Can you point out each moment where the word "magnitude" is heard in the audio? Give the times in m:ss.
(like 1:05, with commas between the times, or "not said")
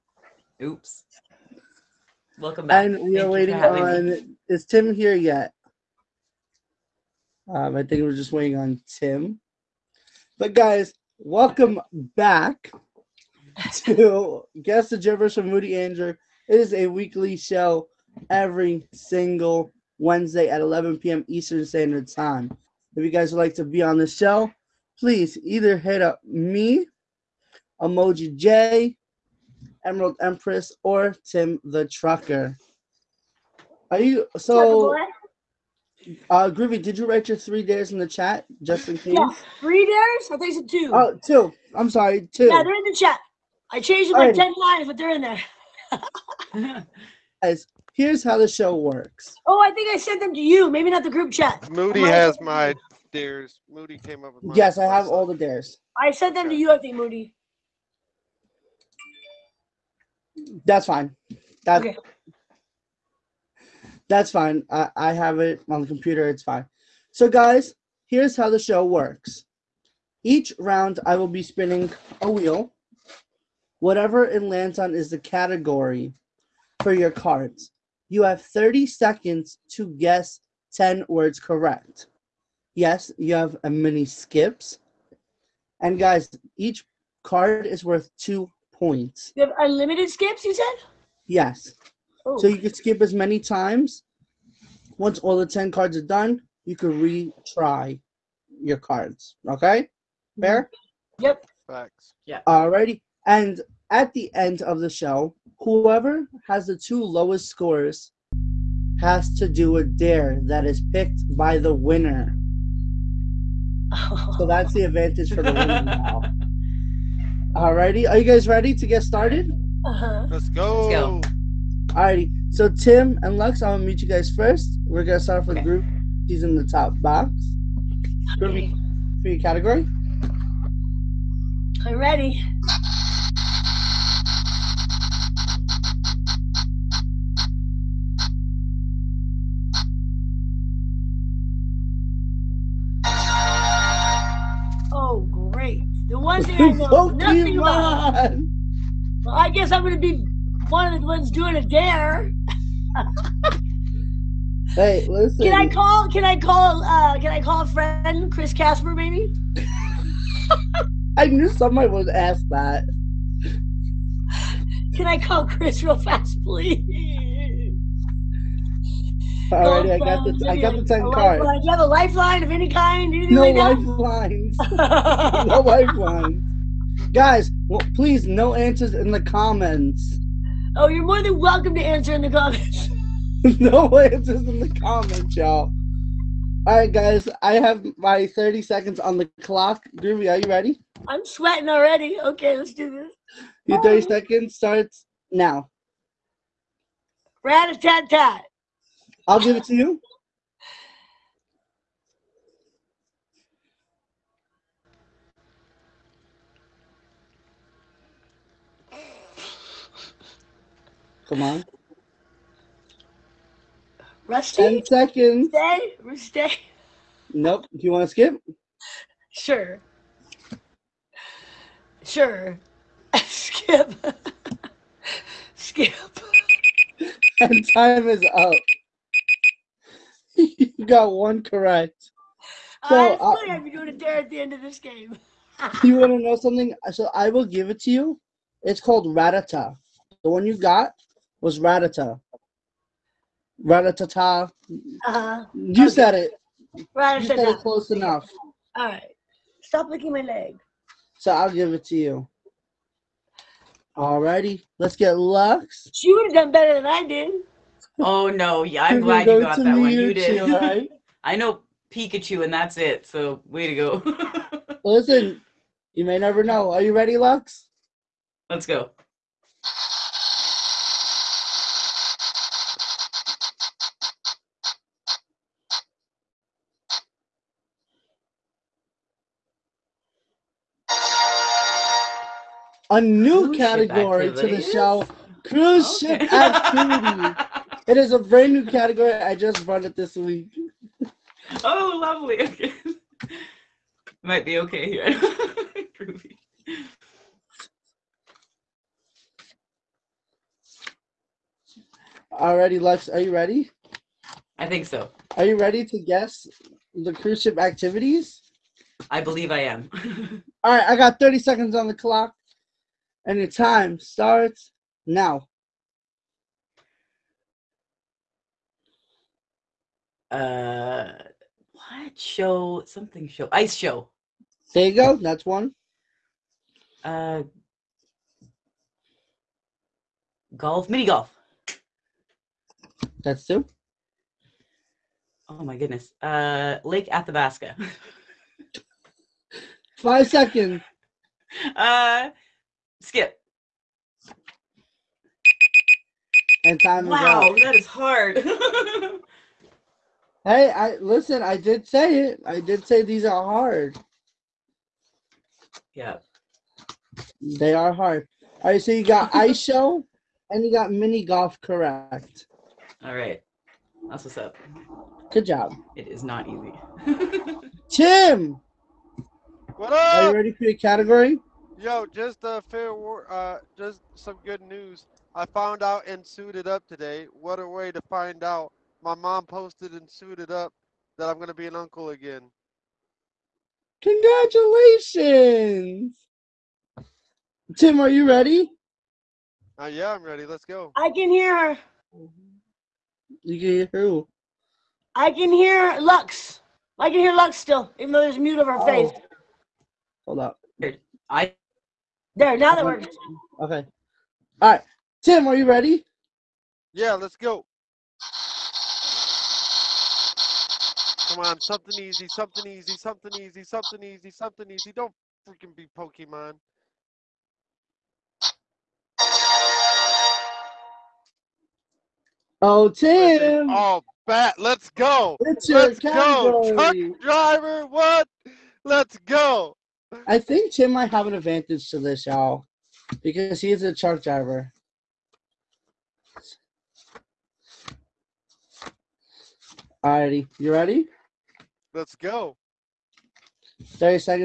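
not said.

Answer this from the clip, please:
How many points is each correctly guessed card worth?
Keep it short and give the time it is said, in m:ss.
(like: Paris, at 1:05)
2, at 1:28.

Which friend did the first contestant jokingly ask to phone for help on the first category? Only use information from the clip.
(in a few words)
Chris Casper.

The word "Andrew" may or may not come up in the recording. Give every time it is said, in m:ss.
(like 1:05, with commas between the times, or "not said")
0:15.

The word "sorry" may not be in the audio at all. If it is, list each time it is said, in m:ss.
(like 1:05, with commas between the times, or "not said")
0:41.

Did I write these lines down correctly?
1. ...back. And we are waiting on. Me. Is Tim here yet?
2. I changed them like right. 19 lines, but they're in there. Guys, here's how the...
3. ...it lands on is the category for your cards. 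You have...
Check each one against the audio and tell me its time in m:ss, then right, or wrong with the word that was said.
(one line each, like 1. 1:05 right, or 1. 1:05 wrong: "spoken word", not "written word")
1. 0:02 right
2. 0:43 wrong: "10", not "19"
3. 1:14 right.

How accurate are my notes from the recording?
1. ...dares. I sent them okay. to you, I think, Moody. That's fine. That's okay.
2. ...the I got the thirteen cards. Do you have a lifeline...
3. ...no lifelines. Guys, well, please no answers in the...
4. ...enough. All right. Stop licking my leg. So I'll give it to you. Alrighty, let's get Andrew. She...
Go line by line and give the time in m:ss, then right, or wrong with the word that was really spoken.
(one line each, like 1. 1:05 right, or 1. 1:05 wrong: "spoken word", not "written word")
1. 0:55 right
2. 2:50 wrong: "ten", not "thirteen"
3. 2:55 right
4. 4:07 wrong: "Lux", not "Andrew".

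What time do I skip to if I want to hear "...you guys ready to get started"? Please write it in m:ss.
1:58.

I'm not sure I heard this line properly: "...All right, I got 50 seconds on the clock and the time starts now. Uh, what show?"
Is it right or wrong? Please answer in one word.
wrong.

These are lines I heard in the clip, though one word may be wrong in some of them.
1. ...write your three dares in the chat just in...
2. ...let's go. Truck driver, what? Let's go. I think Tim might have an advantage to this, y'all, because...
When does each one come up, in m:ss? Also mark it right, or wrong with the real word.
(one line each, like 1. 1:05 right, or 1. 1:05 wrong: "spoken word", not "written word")
1. 0:37 right
2. 7:05 right.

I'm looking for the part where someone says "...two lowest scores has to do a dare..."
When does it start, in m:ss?
1:46.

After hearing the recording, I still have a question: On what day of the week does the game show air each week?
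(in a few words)
Wednesday.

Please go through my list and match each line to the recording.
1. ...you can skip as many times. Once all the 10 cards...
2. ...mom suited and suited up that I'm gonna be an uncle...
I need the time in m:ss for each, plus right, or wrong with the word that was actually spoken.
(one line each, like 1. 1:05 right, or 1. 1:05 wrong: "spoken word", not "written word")
1. 1:32 right
2. 6:19 wrong: "posted", not "suited".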